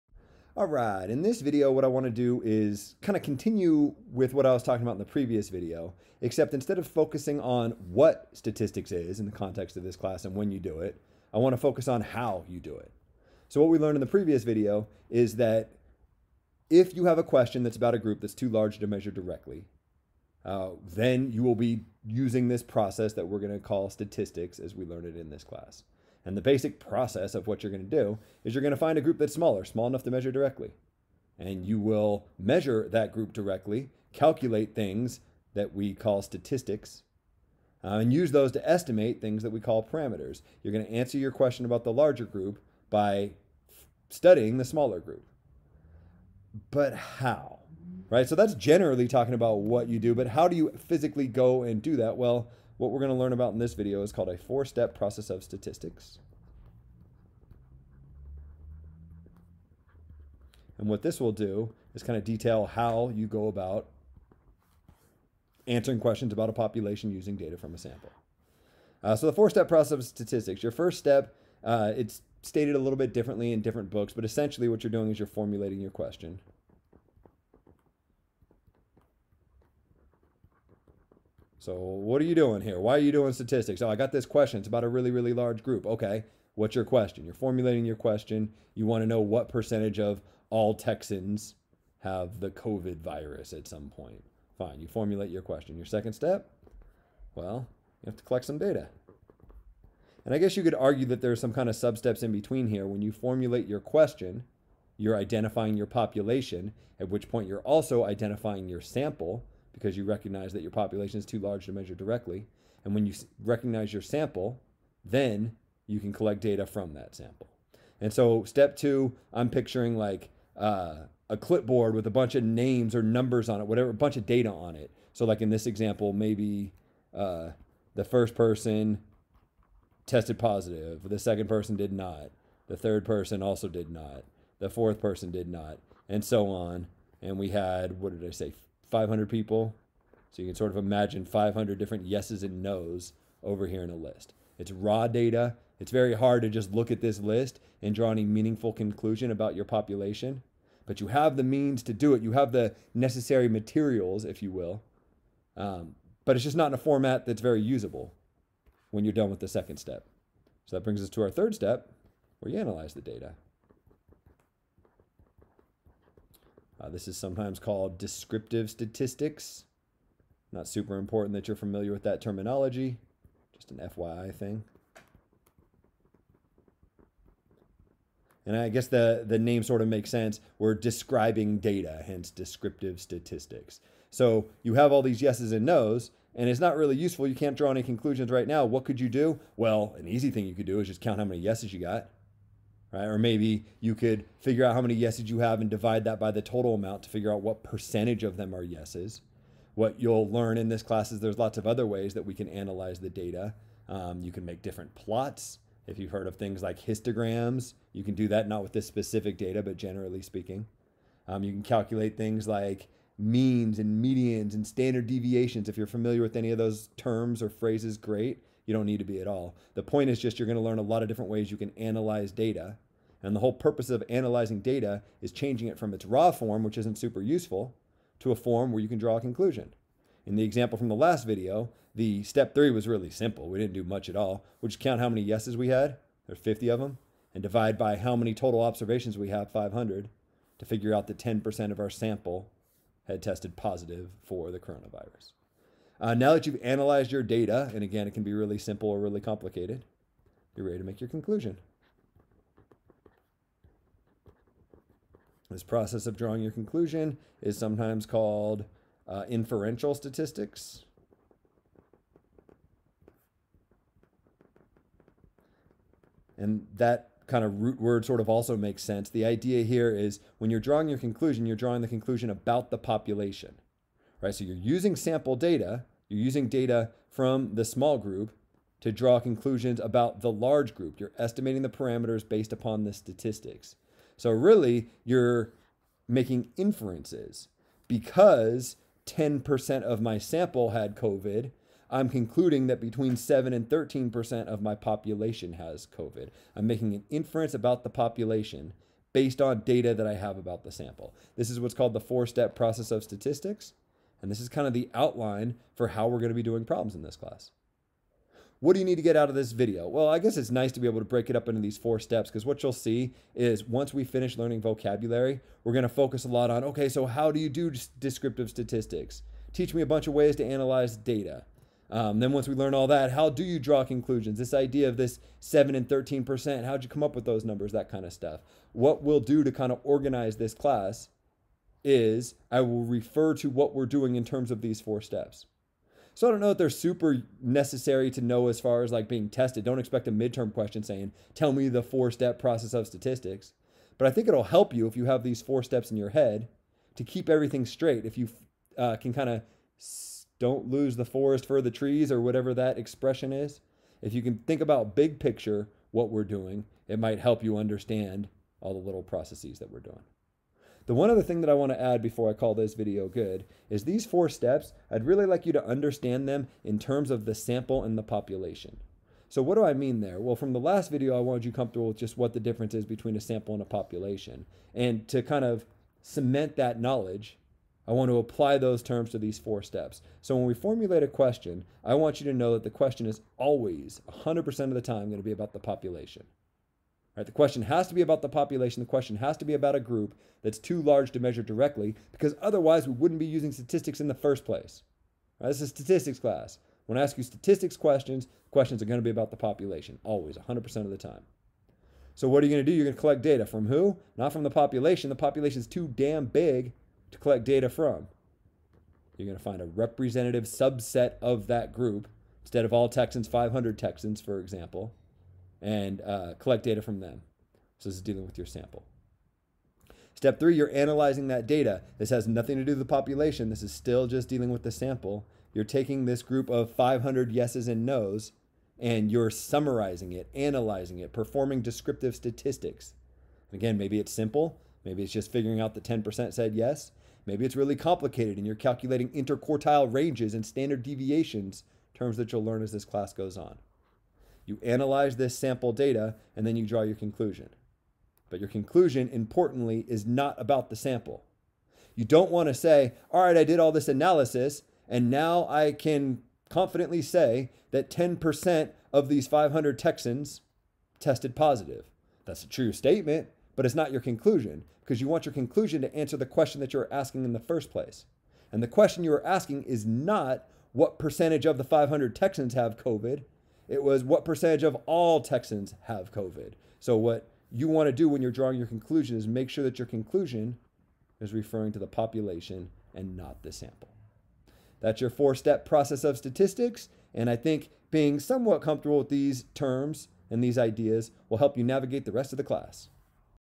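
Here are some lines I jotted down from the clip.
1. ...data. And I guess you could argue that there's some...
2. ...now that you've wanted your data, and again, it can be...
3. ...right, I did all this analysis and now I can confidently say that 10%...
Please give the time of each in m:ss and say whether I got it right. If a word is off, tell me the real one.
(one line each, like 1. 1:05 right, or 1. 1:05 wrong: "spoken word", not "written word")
1. 1:38 right
2. 4:06 wrong: "analyzed", not "wanted"
3. 7:33 right.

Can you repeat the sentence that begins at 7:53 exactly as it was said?
It was what percentage of all Texans have COVID.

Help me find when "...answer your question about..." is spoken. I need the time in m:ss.
0:40.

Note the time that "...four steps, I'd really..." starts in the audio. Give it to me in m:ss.
6:04.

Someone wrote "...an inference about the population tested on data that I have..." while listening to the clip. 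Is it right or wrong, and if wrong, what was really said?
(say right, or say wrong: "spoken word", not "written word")
wrong: "based", not "tested".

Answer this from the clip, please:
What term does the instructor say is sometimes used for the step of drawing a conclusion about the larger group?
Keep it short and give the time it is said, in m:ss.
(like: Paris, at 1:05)
inferential statistics, at 4:19.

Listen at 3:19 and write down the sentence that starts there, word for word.
What you'll learn in this class is there's lots of other ways that we can analyze the data.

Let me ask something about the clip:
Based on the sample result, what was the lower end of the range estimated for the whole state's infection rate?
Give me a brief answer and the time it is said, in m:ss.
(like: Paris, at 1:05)
7%, at 4:52.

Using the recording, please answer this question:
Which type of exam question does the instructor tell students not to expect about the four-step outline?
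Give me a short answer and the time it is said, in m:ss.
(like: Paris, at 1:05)
midterm, at 5:40.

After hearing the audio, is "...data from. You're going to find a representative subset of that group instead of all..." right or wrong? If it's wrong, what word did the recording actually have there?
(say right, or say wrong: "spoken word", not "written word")
right.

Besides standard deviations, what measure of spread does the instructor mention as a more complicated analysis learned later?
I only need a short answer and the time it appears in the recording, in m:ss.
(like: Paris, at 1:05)
interquartile ranges, at 7:19.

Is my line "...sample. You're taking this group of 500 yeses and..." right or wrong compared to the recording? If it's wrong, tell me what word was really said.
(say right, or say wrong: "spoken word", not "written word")
right.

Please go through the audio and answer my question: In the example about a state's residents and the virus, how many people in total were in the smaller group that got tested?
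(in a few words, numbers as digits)
500.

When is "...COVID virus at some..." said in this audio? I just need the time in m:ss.
1:32.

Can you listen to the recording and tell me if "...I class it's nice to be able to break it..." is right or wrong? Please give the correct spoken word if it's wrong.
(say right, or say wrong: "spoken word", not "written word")
wrong: "guess", not "class".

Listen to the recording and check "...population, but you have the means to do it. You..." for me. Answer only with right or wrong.
right.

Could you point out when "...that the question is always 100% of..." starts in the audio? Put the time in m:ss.
6:22.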